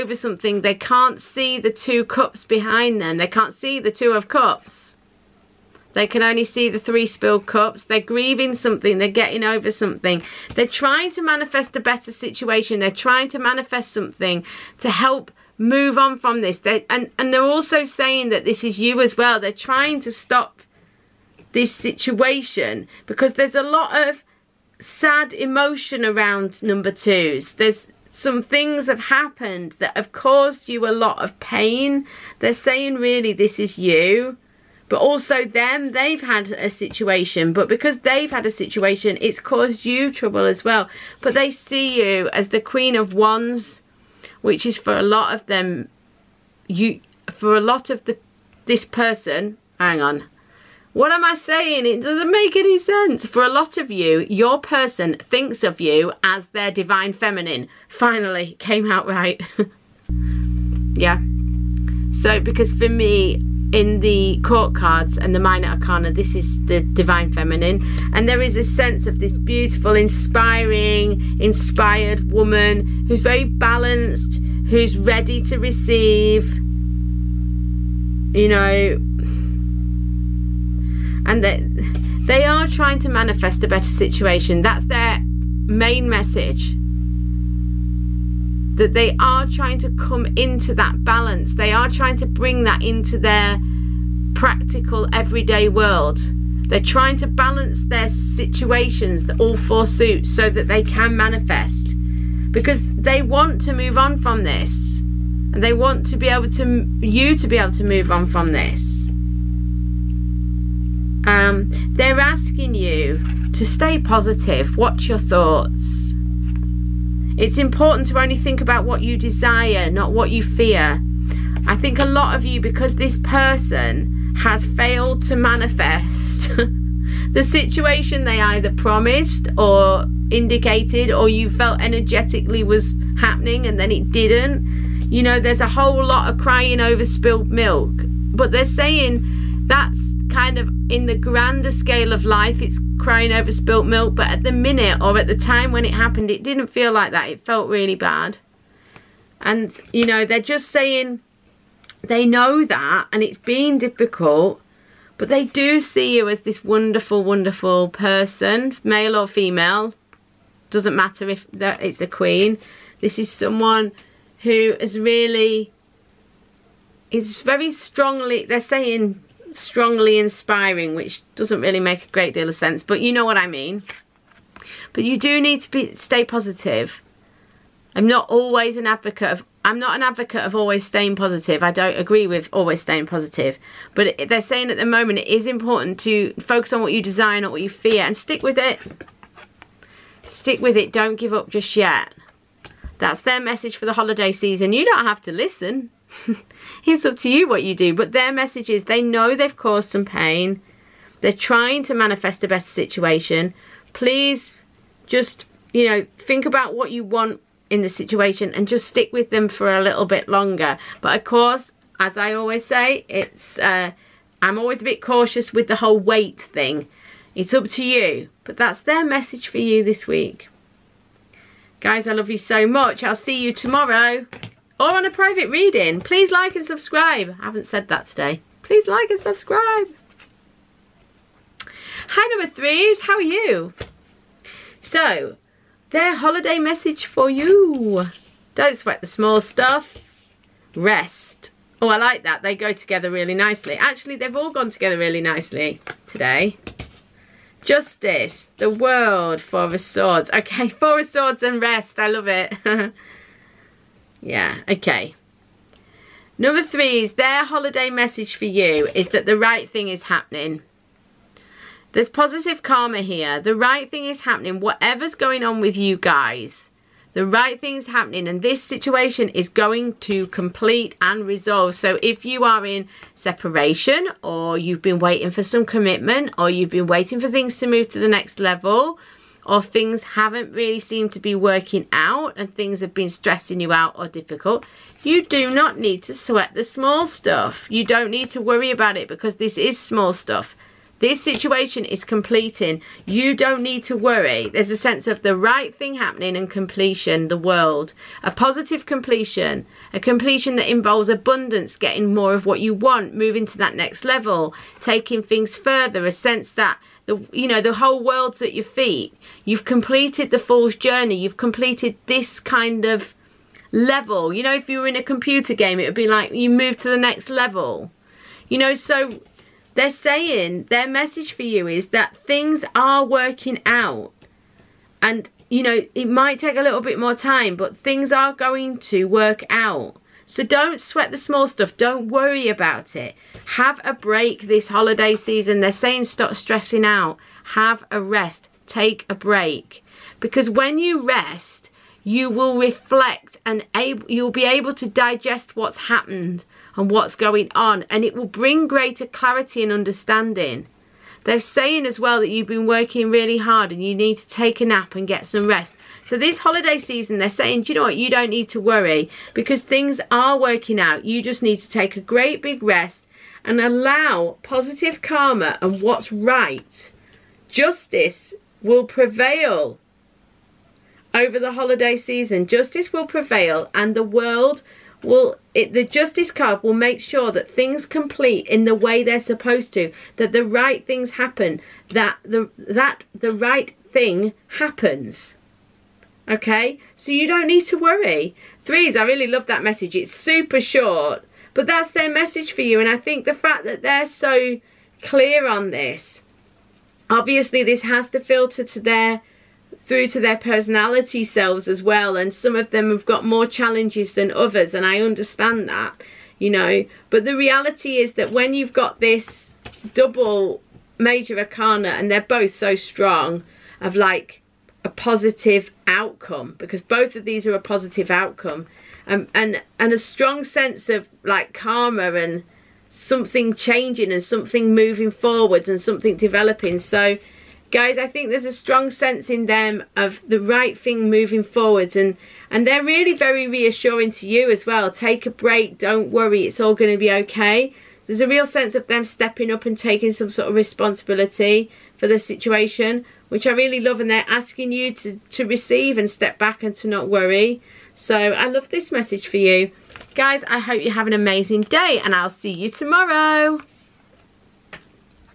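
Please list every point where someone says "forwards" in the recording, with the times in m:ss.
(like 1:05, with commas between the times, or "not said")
7:05, 7:11.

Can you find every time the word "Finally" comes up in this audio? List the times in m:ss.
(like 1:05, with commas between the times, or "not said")
0:57.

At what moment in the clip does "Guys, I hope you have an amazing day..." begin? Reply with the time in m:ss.
7:30.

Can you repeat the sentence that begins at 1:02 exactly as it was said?
So, because for me, in the court cards and the minor arcana, this is the divine feminine.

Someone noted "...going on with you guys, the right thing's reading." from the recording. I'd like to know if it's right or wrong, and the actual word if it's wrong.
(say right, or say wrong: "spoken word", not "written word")
wrong: "happening", not "reading".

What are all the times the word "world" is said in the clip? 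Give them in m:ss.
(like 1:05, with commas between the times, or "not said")
1:35, 4:08, 4:57, 5:08, 6:14.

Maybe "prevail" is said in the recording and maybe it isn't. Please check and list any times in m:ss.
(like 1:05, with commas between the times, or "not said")
6:08, 6:13.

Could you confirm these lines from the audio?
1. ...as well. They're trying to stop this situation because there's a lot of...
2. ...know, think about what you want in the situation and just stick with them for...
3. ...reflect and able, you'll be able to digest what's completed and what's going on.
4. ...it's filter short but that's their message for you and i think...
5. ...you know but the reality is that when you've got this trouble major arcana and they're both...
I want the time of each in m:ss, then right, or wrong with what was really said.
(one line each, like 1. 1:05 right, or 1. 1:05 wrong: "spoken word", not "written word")
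1. 0:19 right
2. 3:25 right
3. 5:42 wrong: "happened", not "completed"
4. 6:29 wrong: "super", not "filter"
5. 6:46 wrong: "double", not "trouble".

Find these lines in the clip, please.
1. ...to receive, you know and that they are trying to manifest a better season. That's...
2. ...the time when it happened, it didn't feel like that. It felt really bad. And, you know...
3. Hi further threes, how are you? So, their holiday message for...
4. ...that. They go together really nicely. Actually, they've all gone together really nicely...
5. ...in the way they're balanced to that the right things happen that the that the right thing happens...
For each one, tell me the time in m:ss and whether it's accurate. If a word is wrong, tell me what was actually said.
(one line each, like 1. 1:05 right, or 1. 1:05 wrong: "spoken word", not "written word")
1. 1:15 wrong: "situation", not "season"
2. 2:25 right
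3. 3:52 wrong: "number", not "further"
4. 4:02 right
5. 6:18 wrong: "supposed", not "balanced".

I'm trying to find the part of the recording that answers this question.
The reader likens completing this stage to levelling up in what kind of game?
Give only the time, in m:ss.
5:15.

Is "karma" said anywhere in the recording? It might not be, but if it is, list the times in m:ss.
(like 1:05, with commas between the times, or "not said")
4:22, 6:05, 7:01.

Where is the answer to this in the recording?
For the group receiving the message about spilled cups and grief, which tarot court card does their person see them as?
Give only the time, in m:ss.
0:42.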